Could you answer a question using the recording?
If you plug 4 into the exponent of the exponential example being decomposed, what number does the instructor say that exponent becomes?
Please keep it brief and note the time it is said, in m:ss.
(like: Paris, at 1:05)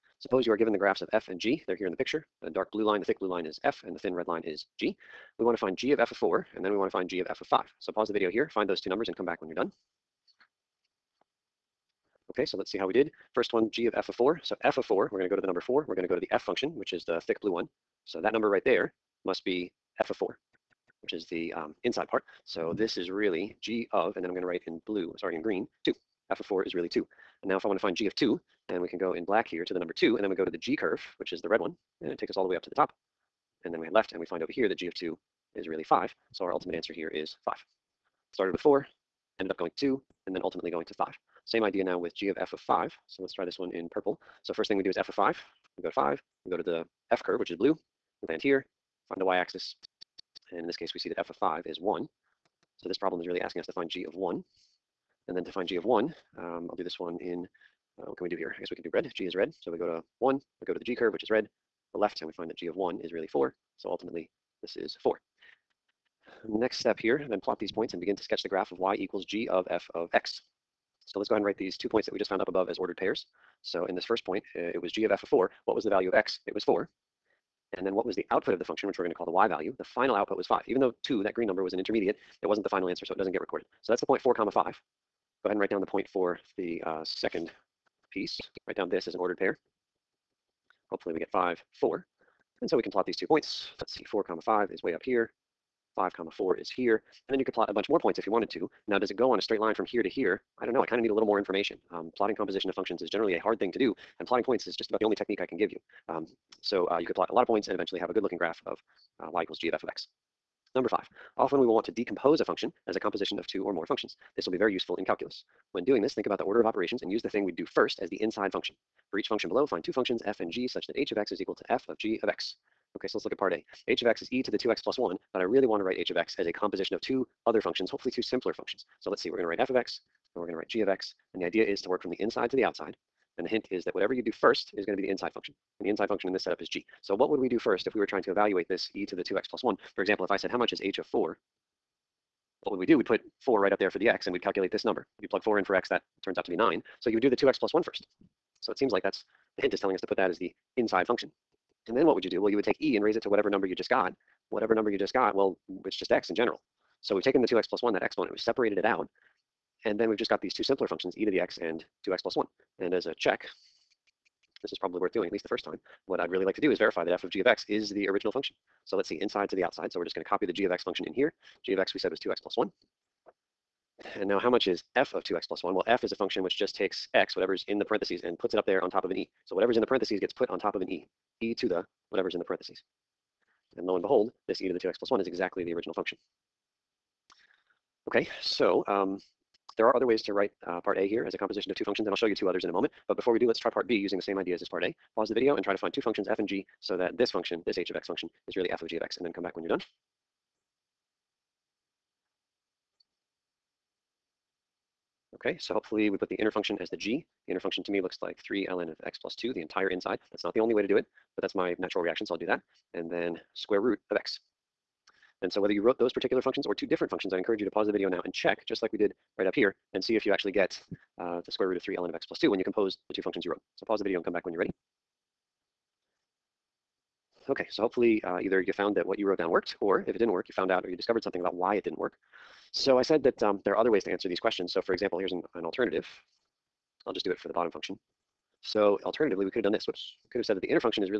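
9, at 2:25.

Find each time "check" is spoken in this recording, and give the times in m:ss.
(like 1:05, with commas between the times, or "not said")
2:43, 3:38.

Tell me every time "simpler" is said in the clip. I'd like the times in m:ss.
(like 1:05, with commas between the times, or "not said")
2:08, 2:40.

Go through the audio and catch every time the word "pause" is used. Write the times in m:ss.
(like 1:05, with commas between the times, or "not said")
0:07, 3:15, 3:37, 3:43.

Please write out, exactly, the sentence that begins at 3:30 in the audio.
That's not the only way to do it, but that's my natural reaction, so I'll do that.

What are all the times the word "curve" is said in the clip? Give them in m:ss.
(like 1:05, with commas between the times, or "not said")
0:30, 0:47, 1:00.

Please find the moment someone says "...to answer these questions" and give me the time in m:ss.
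3:54.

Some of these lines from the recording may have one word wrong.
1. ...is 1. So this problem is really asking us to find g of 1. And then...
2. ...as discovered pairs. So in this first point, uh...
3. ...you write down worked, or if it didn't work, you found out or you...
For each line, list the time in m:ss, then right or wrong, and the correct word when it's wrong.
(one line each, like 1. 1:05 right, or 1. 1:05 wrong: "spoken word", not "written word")
1. 0:51 right
2. 1:12 wrong: "ordered", not "discovered"
3. 3:49 wrong: "wrote", not "write".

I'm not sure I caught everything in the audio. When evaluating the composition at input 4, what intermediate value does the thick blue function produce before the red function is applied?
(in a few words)
2.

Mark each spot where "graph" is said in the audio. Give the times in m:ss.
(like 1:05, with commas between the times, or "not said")
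0:00, 1:08, 1:48.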